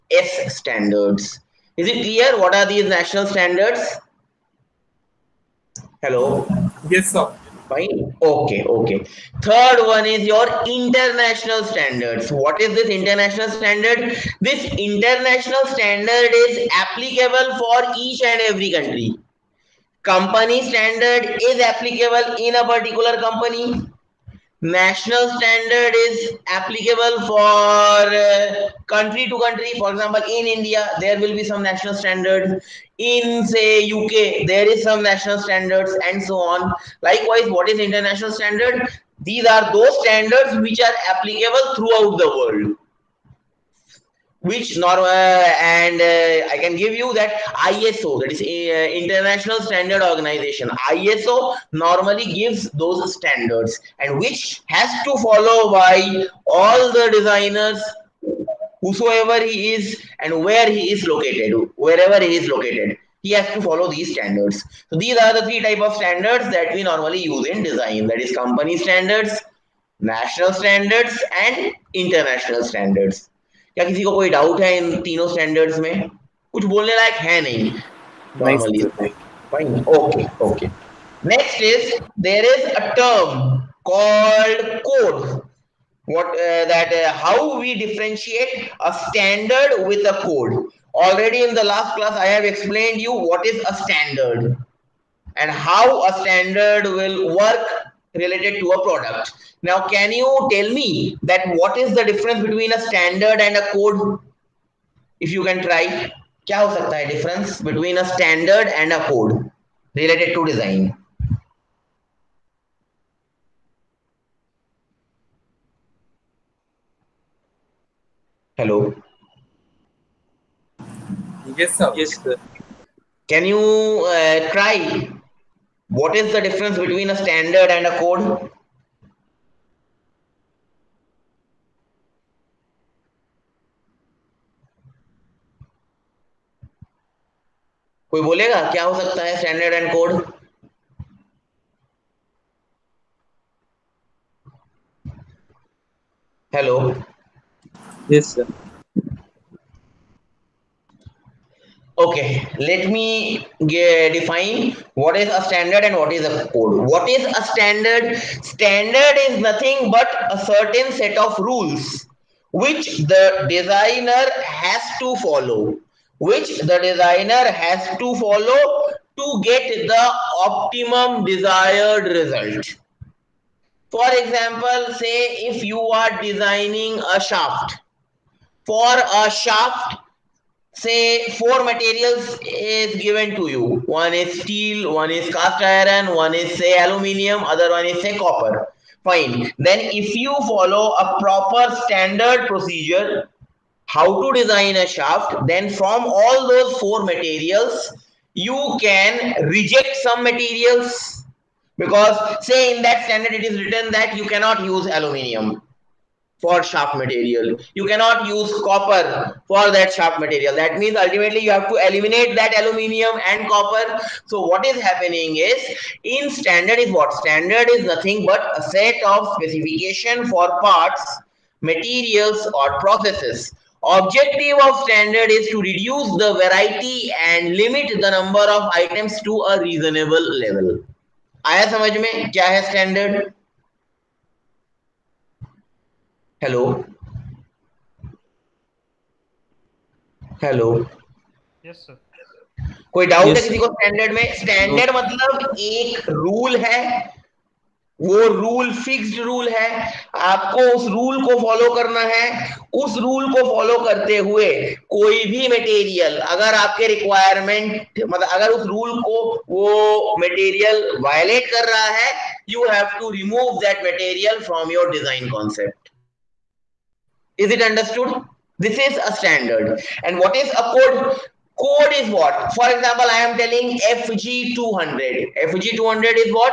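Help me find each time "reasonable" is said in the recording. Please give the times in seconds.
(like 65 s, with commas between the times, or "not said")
229 s.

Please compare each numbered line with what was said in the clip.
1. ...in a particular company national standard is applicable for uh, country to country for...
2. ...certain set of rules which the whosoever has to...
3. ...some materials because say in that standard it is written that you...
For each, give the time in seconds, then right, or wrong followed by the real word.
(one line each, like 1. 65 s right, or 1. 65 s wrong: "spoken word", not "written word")
1. 22 s right
2. 160 s wrong: "designer", not "whosoever"
3. 200 s right.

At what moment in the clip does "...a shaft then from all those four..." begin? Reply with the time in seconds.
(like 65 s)
194 s.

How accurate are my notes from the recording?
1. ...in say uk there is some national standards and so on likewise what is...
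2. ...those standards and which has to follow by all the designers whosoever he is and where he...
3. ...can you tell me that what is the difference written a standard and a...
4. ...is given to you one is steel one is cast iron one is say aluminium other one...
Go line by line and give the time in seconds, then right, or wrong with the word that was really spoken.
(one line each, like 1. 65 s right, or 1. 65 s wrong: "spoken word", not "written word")
1. 32 s right
2. 52 s right
3. 99 s wrong: "between", not "written"
4. 182 s right.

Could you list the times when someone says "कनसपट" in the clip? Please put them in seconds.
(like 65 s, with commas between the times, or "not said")
265 s.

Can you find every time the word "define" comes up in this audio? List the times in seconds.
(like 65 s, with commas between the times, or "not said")
154 s.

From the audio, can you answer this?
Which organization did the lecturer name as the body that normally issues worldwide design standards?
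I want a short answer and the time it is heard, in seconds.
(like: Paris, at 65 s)
International Standard Organization, at 48 s.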